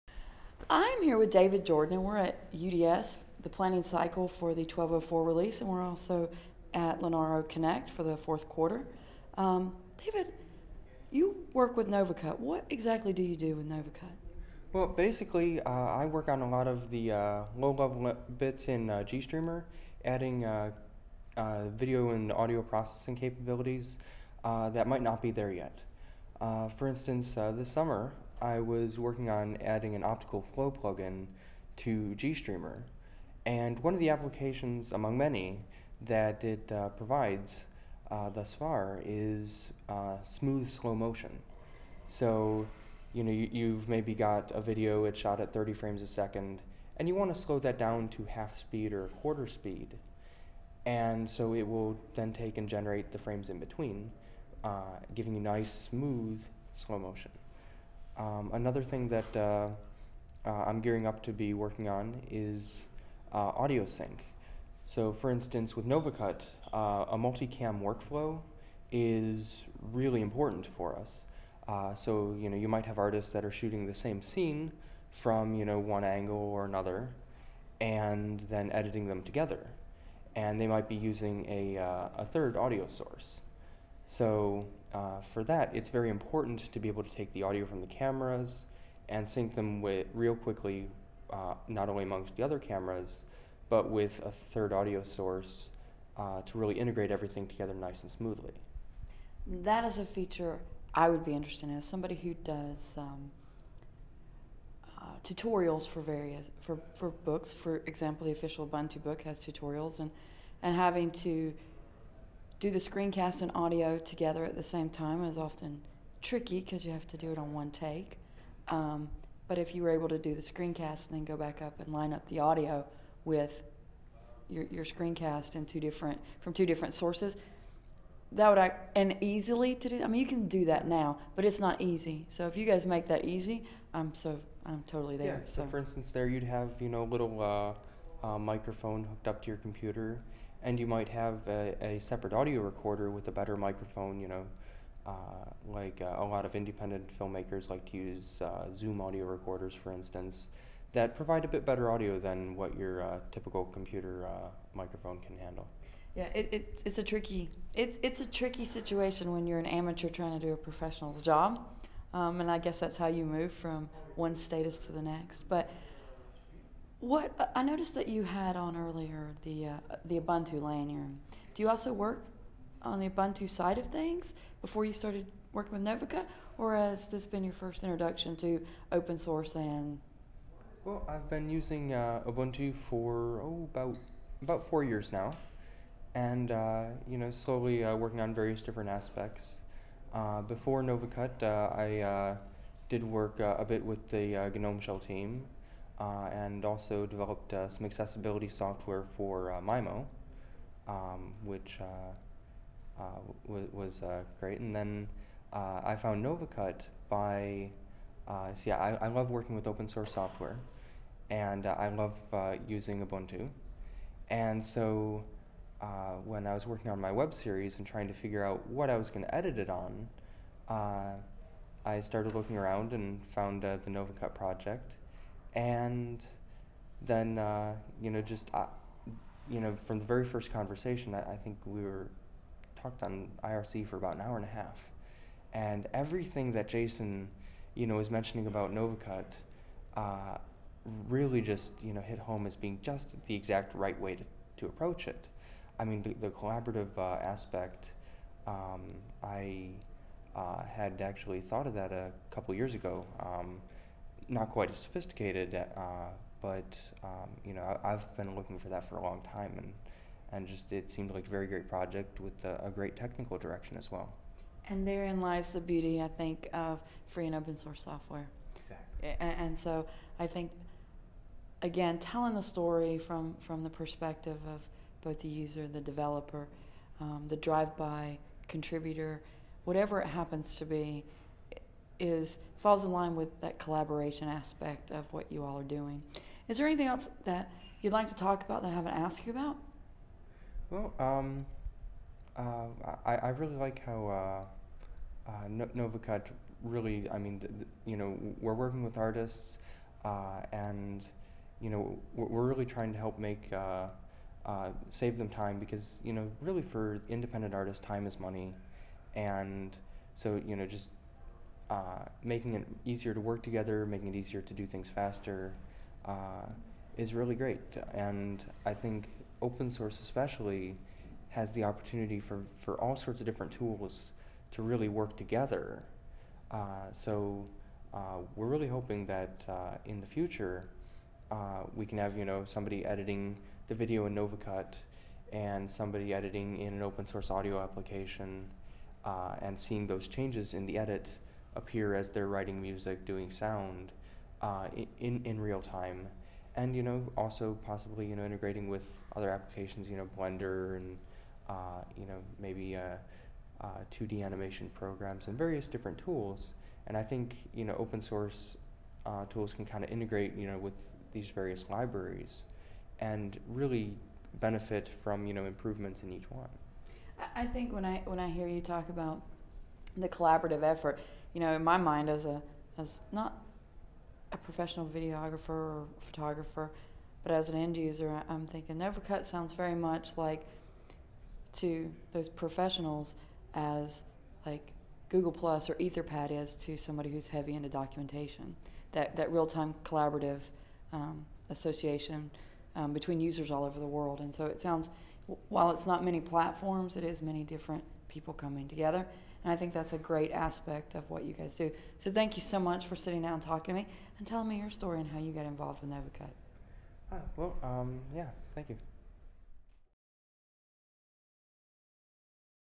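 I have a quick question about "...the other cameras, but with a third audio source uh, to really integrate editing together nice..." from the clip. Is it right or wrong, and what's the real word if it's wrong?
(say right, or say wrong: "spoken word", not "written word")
wrong: "everything", not "editing".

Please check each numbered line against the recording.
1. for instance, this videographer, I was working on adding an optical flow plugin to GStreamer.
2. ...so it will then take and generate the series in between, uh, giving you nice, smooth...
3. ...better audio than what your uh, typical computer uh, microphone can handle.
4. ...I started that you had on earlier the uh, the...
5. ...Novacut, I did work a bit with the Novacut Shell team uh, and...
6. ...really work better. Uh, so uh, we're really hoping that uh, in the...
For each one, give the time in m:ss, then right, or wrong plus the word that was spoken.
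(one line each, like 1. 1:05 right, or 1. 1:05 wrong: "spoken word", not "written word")
1. 0:26 wrong: "summer", not "videographer"
2. 0:51 wrong: "frames", not "series"
3. 2:31 right
4. 2:47 wrong: "noticed", not "started"
5. 3:10 wrong: "GNOME", not "Novacut"
6. 5:24 wrong: "together", not "better".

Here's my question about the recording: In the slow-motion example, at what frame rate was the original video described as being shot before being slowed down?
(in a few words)
30 frames a second.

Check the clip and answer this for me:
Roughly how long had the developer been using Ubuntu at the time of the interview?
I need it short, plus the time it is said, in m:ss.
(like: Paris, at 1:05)
About 4 years, at 3:04.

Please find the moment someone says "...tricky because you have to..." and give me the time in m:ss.
1:56.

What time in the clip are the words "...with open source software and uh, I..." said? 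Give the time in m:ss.
3:29.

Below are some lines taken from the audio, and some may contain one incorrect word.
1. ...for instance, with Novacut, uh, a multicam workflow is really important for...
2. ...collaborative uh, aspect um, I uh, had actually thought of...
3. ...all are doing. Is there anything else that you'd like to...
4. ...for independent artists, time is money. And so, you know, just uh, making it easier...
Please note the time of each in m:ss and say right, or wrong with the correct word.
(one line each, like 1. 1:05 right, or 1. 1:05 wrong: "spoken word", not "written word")
1. 1:05 right
2. 4:06 right
3. 4:45 right
4. 5:06 right.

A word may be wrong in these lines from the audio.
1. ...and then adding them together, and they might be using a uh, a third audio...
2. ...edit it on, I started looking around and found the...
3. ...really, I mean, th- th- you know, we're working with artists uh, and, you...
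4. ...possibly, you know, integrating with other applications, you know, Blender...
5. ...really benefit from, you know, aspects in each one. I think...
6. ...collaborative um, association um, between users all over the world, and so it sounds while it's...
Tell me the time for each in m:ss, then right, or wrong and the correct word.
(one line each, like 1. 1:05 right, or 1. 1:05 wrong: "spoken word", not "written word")
1. 1:17 wrong: "editing", not "adding"
2. 3:39 right
3. 4:56 right
4. 5:47 right
5. 6:03 wrong: "improvements", not "aspects"
6. 6:29 right.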